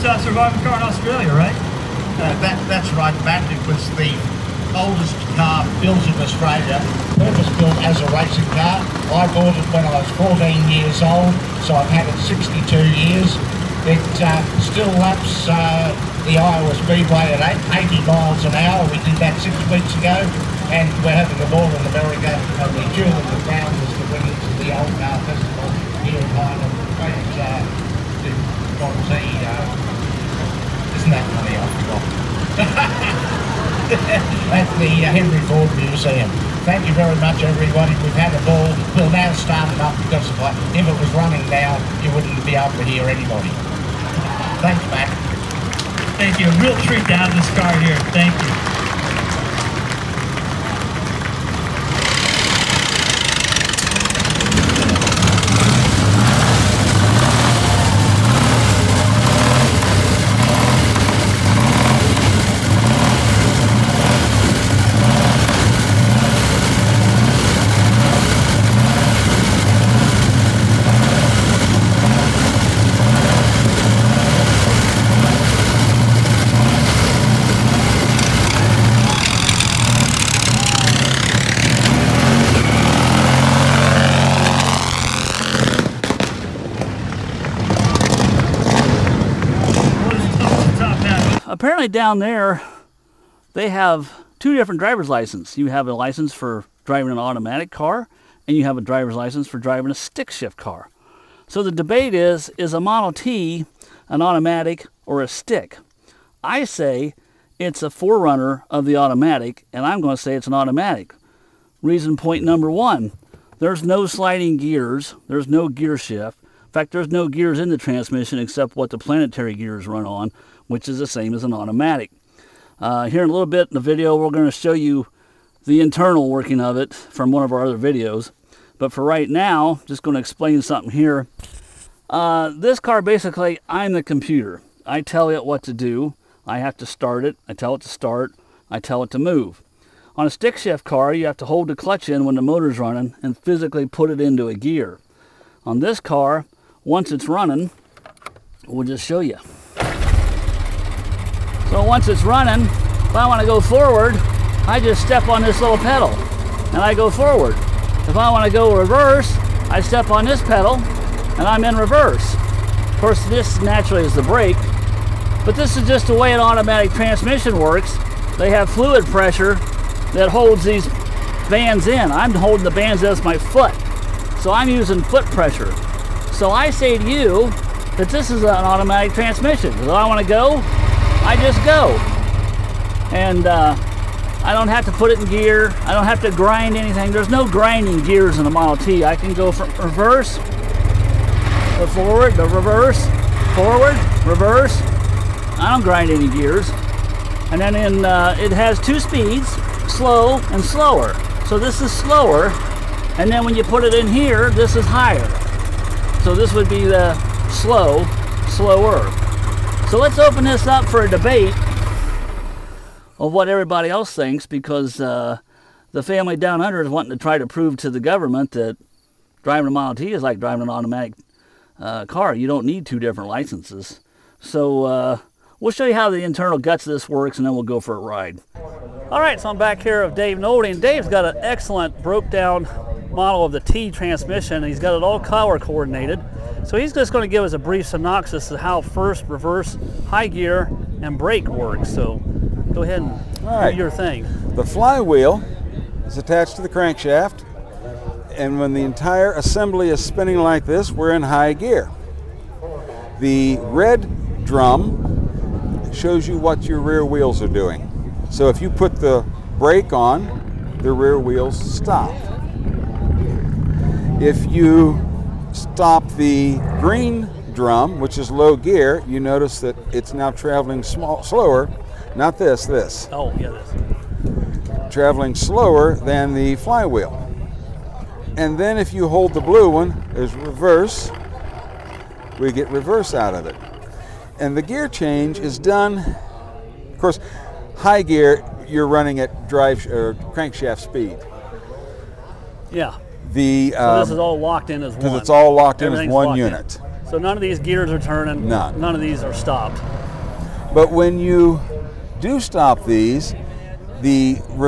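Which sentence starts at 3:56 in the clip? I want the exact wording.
So he's just going to give us a brief synopsis of how first, reverse, high gear, and brake works.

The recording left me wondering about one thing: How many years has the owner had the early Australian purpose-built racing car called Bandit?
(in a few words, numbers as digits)
62.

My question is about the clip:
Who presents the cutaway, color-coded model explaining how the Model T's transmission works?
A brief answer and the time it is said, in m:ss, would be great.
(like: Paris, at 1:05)
Dave Nolte, at 3:50.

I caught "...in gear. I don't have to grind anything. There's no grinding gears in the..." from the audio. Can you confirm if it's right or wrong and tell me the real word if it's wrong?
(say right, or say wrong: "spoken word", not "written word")
right.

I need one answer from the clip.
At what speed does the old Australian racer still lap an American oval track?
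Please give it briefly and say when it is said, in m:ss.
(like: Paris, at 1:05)
80 miles an hour, at 0:17.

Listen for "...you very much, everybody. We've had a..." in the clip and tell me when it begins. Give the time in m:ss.
0:36.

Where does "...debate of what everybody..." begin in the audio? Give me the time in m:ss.
3:31.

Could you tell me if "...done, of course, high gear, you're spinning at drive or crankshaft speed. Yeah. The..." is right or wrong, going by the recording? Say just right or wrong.
wrong.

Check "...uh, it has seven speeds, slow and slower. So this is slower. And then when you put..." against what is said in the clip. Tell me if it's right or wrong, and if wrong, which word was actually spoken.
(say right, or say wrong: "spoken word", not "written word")
wrong: "two", not "seven".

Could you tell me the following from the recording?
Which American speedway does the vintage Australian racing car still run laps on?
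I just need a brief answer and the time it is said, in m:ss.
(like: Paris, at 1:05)
Iowa Speedway, at 0:16.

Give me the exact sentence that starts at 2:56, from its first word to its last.
So I say to you that this is an automatic transmission.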